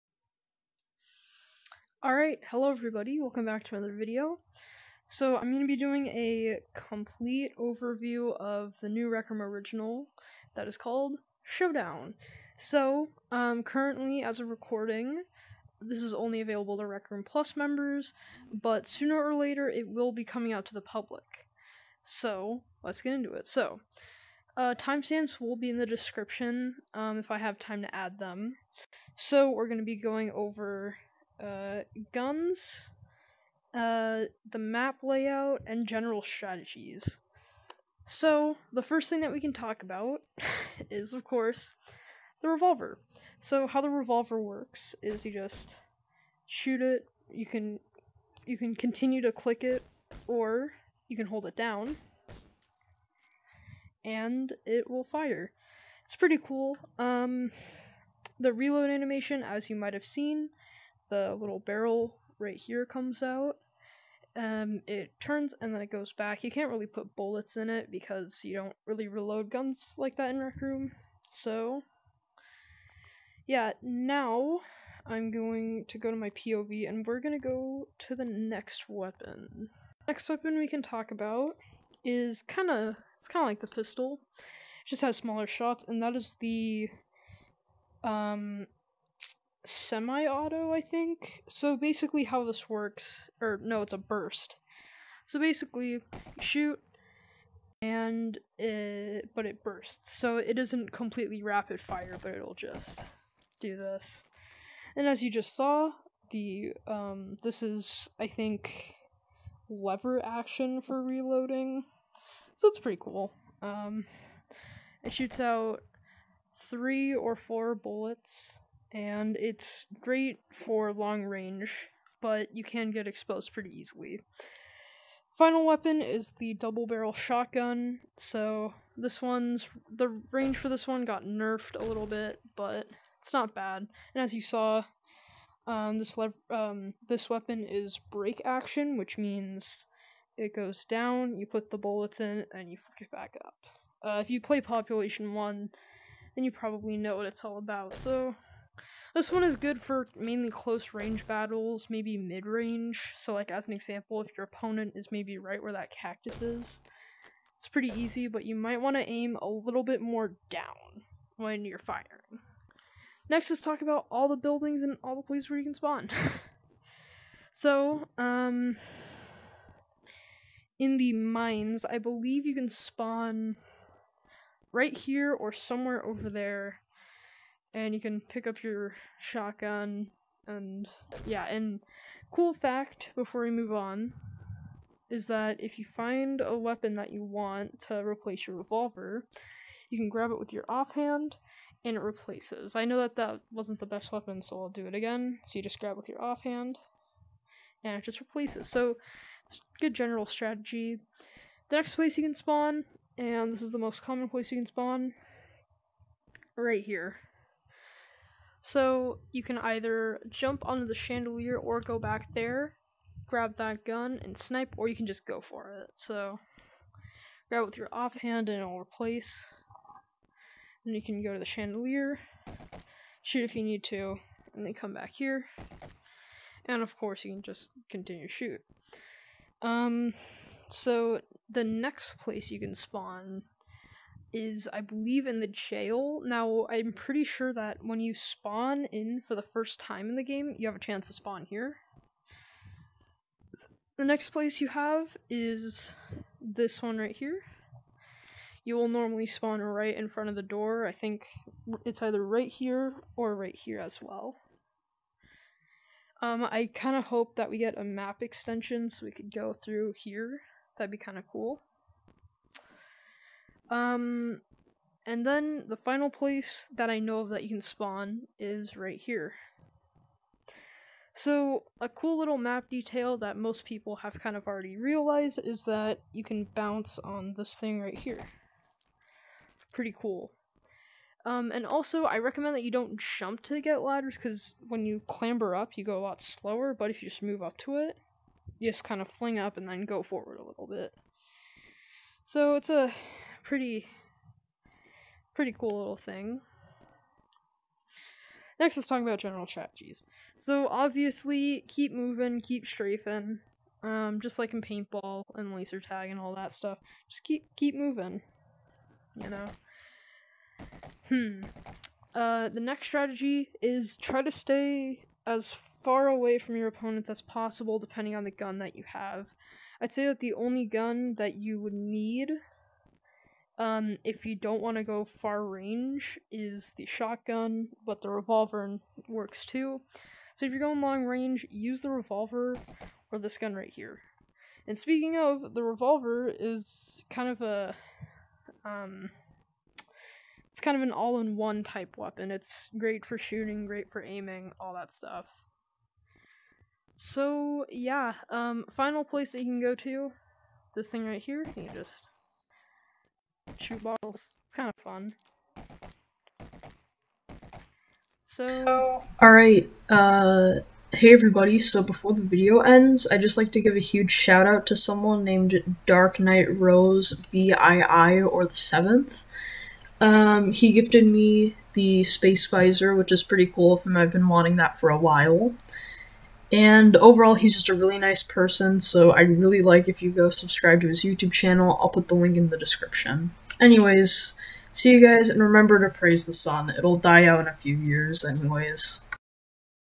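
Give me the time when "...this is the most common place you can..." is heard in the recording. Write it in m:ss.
3:23.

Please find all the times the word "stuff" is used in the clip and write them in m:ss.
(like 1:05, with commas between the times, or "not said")
5:06, 5:44.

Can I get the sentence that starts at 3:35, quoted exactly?
So grab it with your offhand and it'll replace.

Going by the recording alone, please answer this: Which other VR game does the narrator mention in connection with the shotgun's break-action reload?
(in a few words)
Population One.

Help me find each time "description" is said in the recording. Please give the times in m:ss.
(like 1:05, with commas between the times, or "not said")
0:25, 6:22.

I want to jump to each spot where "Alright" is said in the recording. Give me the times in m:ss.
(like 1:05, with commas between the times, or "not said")
0:02, 5:59.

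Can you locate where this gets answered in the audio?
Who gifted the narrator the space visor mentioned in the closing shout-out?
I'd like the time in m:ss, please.
6:05.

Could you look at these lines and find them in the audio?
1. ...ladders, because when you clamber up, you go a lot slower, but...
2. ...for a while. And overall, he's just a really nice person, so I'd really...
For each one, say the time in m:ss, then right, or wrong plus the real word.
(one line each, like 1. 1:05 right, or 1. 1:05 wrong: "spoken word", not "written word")
1. 4:43 right
2. 6:14 right.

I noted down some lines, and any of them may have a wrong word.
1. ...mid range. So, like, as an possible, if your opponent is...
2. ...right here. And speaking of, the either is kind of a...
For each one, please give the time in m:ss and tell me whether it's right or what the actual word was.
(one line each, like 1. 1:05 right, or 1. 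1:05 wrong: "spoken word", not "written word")
1. 2:32 wrong: "example", not "possible"
2. 5:33 wrong: "revolver", not "either".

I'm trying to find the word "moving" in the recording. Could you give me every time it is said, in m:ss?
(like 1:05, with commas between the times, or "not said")
5:01, 5:07.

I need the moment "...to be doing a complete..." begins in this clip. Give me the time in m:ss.
0:05.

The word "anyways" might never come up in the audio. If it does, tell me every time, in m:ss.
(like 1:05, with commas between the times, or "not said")
6:23, 6:28.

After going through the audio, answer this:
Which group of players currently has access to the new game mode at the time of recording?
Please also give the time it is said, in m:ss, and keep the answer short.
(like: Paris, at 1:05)
Rec Plus members, at 0:16.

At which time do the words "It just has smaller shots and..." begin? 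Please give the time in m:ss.
1:24.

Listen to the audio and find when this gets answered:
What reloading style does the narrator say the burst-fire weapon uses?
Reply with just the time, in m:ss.
1:49.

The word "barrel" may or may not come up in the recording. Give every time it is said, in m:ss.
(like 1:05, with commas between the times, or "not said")
1:01, 2:06.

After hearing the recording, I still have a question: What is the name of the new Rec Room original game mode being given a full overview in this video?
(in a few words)
Showdown.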